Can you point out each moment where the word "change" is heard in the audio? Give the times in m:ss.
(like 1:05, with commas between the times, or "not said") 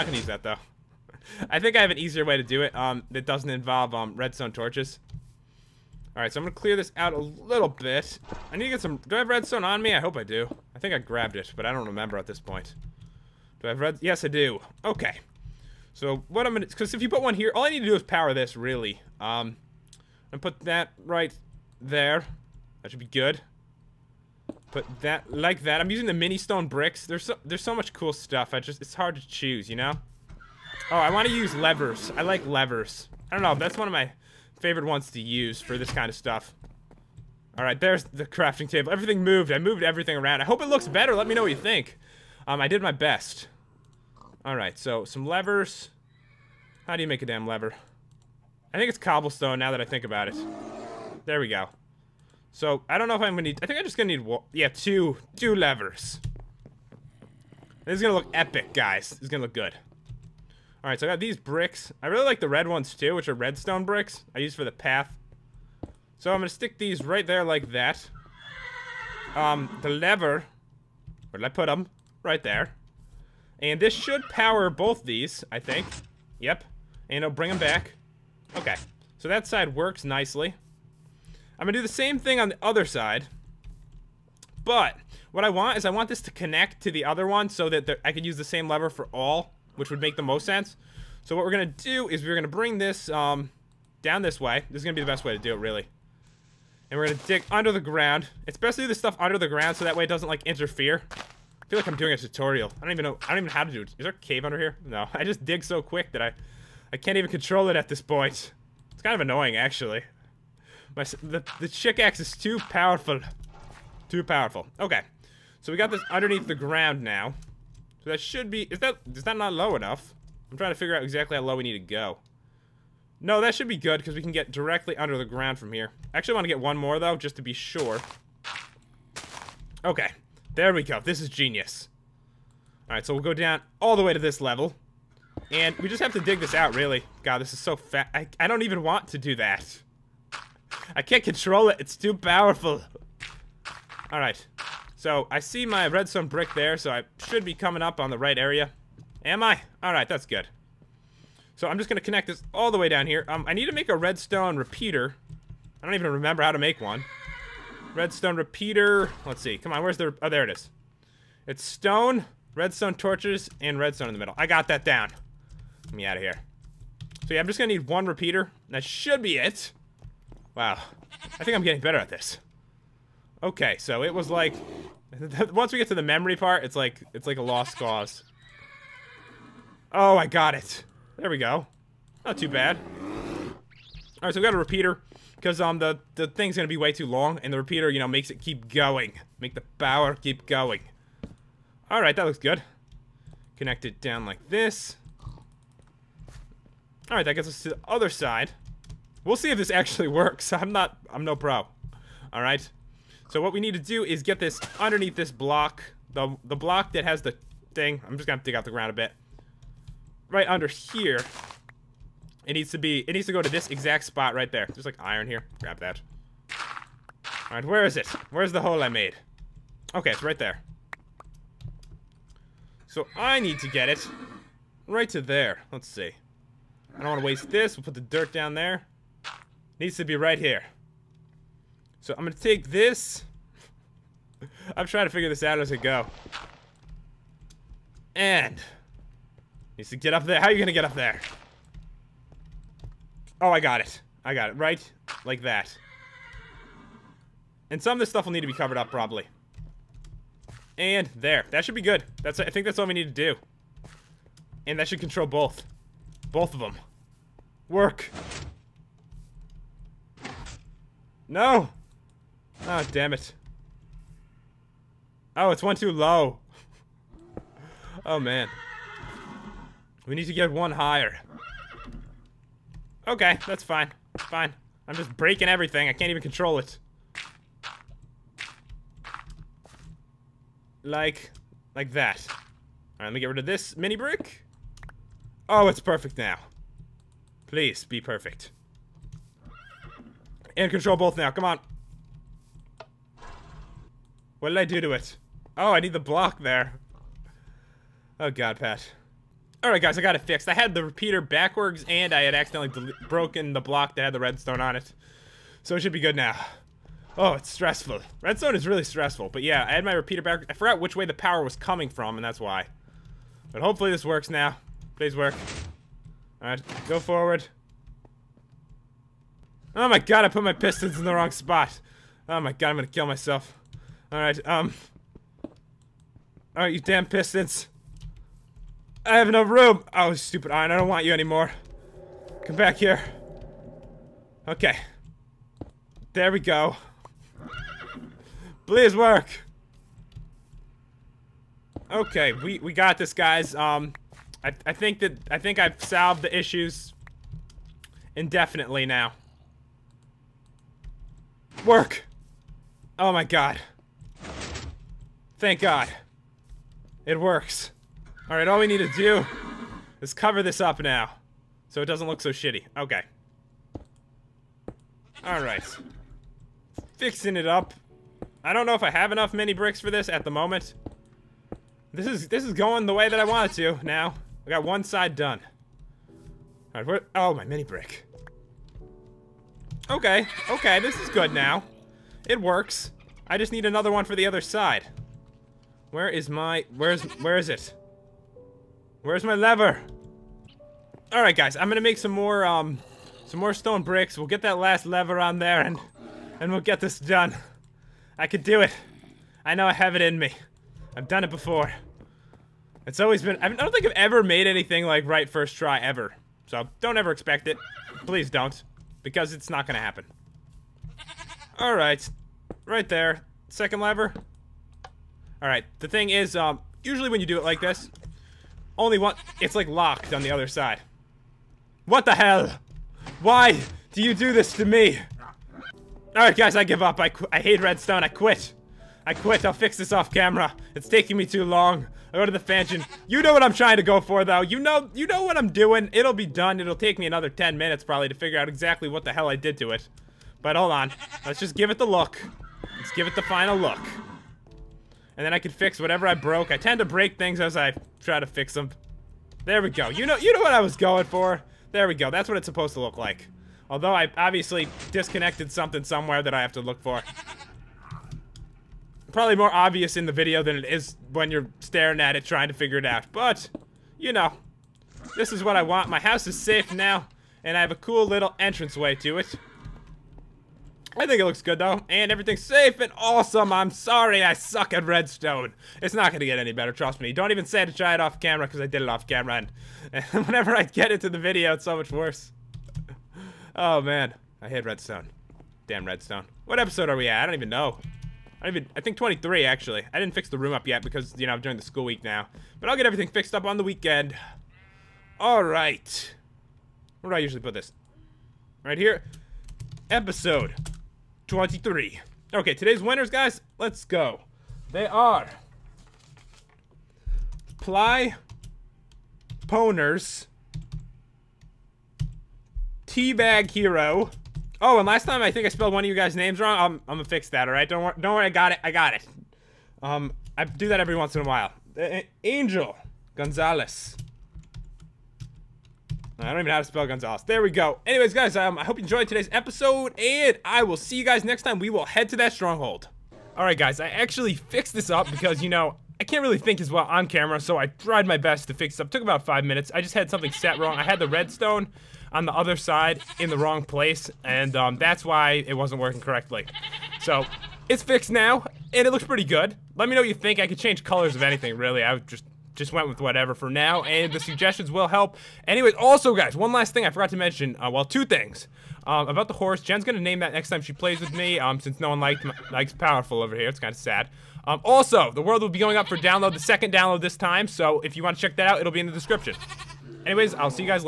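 9:10.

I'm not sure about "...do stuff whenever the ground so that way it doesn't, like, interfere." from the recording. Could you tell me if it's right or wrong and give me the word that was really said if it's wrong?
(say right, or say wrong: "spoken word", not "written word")
wrong: "under", not "whenever".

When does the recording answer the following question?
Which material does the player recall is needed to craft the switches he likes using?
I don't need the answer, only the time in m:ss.
0:48.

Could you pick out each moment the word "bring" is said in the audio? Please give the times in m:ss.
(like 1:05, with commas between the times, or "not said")
1:17, 1:32.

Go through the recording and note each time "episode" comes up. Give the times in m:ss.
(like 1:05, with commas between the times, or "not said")
8:06, 8:19, 8:49.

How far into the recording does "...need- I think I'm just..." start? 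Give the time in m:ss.
0:53.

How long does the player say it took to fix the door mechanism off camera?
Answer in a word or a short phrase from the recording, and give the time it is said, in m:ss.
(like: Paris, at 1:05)
About five minutes, at 8:59.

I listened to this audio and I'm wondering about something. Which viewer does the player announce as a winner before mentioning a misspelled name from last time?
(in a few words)
Teabag Hero.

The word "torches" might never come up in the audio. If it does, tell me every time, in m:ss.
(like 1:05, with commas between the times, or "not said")
0:04, 2:42.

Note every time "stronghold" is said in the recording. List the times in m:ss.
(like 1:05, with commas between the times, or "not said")
8:52.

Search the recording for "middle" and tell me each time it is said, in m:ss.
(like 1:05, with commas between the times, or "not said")
2:44.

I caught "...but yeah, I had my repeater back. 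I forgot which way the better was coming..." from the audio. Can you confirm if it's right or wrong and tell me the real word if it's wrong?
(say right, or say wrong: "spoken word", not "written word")
wrong: "power", not "better".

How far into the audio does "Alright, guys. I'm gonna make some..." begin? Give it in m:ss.
6:31.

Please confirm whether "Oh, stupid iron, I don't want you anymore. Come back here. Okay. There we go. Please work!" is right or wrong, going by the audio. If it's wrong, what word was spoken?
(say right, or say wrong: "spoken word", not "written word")
right.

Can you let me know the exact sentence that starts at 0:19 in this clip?
Um, and put that right there.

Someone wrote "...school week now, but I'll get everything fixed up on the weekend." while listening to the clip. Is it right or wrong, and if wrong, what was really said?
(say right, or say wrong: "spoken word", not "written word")
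right.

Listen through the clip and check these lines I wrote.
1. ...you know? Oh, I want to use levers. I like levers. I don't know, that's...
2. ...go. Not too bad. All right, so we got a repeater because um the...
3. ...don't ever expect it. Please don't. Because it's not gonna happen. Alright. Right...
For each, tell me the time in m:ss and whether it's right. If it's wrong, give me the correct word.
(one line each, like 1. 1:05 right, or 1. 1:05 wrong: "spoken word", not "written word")
1. 0:29 right
2. 3:01 right
3. 6:46 right.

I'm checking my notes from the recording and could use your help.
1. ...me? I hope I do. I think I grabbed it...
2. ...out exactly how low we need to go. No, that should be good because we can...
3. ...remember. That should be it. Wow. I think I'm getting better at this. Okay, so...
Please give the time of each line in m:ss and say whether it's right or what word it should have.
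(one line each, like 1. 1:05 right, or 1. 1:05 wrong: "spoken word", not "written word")
1. 0:09 right
2. 2:00 right
3. 2:48 wrong: "repeater", not "remember".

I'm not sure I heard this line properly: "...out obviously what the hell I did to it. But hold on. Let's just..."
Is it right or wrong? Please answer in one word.
wrong.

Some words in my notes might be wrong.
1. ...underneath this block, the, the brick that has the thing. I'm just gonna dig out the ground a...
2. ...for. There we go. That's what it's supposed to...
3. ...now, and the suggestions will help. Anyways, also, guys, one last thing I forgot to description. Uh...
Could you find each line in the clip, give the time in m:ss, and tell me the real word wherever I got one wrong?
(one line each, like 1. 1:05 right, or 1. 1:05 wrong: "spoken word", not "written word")
1. 3:24 wrong: "block", not "brick"
2. 7:31 right
3. 9:13 wrong: "mention", not "description".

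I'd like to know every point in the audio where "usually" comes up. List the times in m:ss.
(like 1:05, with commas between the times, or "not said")
6:56, 8:17.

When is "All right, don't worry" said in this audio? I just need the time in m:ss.
8:37.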